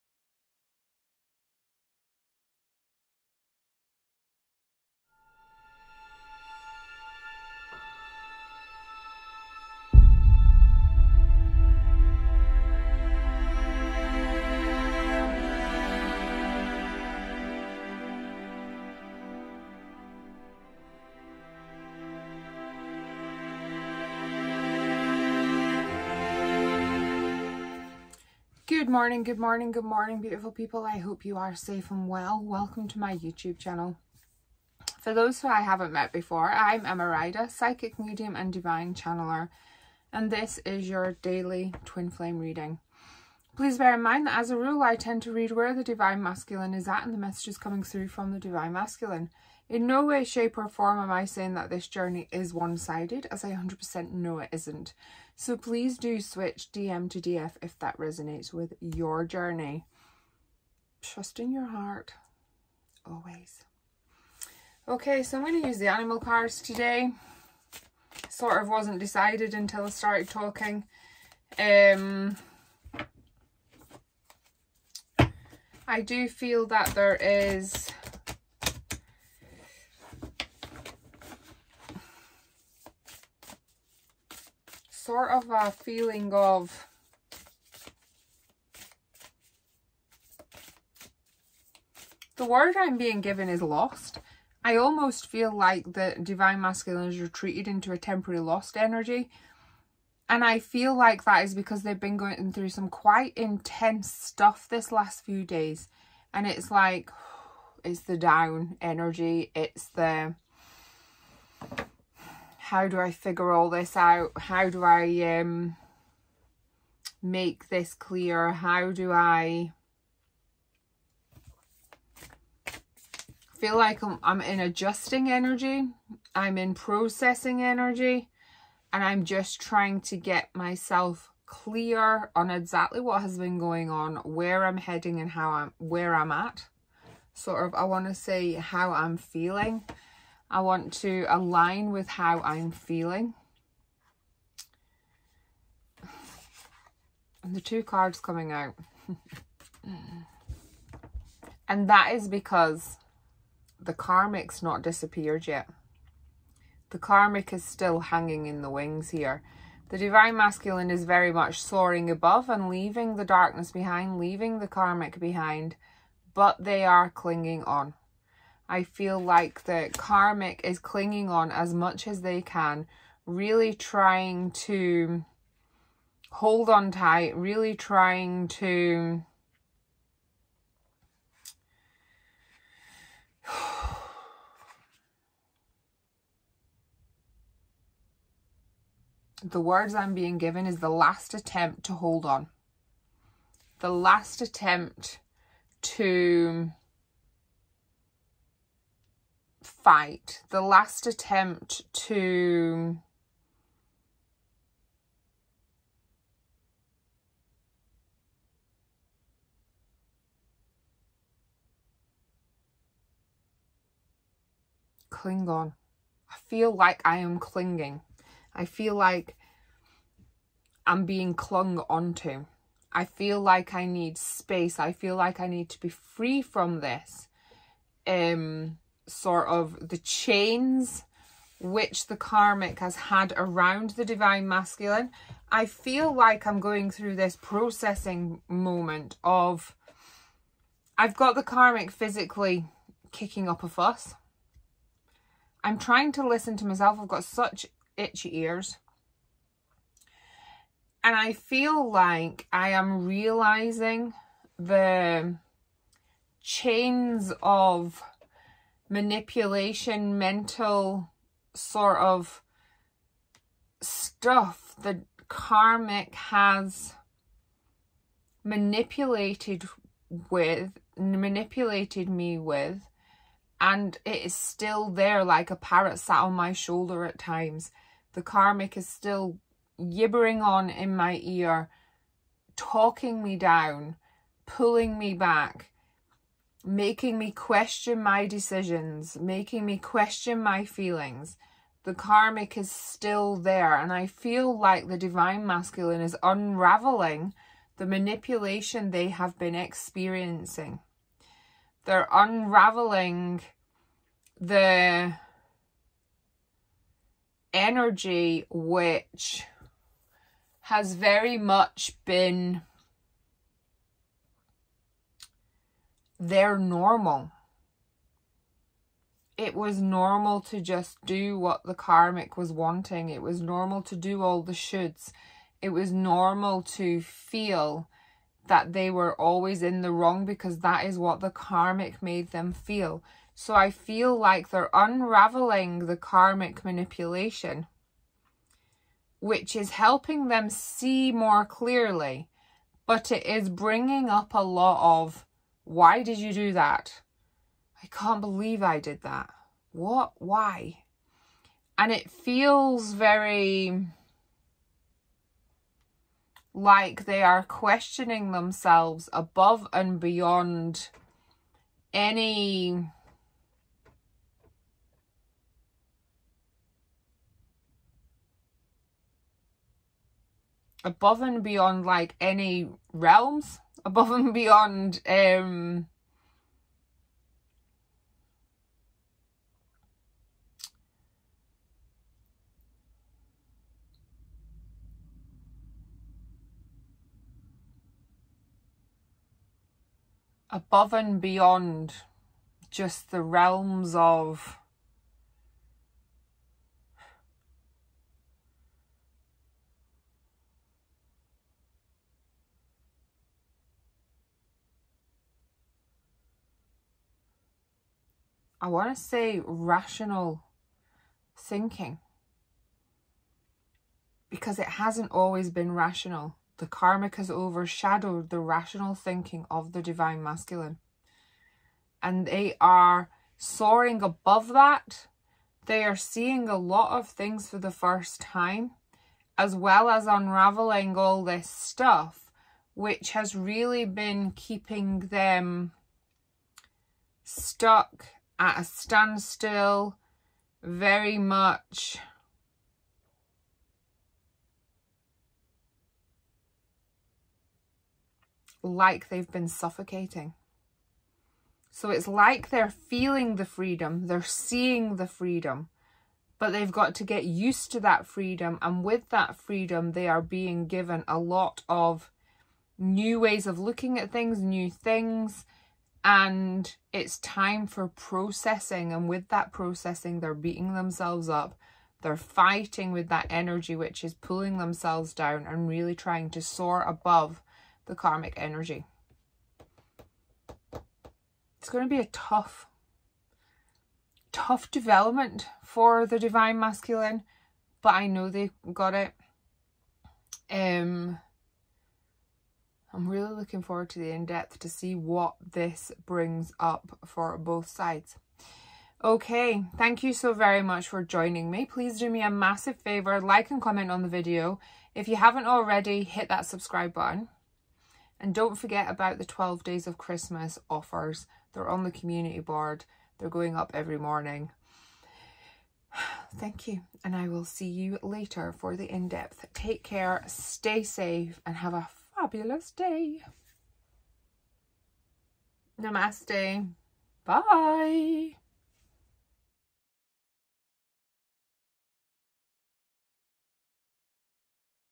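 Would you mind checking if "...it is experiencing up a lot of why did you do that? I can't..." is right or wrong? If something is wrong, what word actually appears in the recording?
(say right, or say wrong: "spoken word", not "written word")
wrong: "bringing", not "experiencing".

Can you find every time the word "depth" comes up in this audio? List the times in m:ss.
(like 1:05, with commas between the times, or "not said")
8:14, 8:38.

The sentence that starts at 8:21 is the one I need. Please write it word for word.
Please do me a massive favor, like and comment on the video.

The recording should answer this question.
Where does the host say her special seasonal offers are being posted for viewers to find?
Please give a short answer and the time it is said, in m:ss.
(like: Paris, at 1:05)
community board, at 8:31.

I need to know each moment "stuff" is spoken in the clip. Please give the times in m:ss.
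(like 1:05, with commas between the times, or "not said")
1:44, 4:23, 7:11.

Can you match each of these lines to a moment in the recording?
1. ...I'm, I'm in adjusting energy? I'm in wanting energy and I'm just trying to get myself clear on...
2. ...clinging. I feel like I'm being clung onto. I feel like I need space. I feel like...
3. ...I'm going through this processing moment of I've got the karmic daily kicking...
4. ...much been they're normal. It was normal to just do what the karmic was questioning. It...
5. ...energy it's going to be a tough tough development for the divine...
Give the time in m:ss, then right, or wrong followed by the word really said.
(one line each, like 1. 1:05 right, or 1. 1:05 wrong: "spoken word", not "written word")
1. 2:04 wrong: "processing", not "wanting"
2. 3:37 right
3. 3:56 wrong: "physically", not "daily"
4. 5:11 wrong: "wanting", not "questioning"
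5. 7:58 right.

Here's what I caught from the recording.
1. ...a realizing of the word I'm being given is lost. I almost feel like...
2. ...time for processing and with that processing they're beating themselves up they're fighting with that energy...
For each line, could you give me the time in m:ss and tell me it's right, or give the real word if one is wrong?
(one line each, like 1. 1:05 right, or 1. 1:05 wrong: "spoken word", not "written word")
1. 1:25 wrong: "feeling", not "realizing"
2. 7:47 right.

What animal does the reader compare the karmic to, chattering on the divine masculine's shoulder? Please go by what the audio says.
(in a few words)
parrot.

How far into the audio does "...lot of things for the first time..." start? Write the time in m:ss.
7:06.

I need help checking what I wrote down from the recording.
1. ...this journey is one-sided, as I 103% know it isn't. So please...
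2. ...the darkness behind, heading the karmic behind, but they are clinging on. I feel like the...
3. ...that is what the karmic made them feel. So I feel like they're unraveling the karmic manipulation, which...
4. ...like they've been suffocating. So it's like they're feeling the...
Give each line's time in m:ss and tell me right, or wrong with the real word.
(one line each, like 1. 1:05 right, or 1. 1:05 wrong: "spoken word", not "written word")
1. 0:51 wrong: "100", not "103"
2. 2:43 wrong: "leaving", not "heading"
3. 5:30 right
4. 7:28 right.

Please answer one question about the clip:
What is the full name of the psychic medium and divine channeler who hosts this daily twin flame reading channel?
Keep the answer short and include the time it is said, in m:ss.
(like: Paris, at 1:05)
Emma Ryder, at 0:36.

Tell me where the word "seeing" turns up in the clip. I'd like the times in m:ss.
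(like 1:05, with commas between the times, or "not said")
7:05, 7:34.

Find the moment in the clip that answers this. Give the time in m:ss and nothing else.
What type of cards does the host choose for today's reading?
1:05.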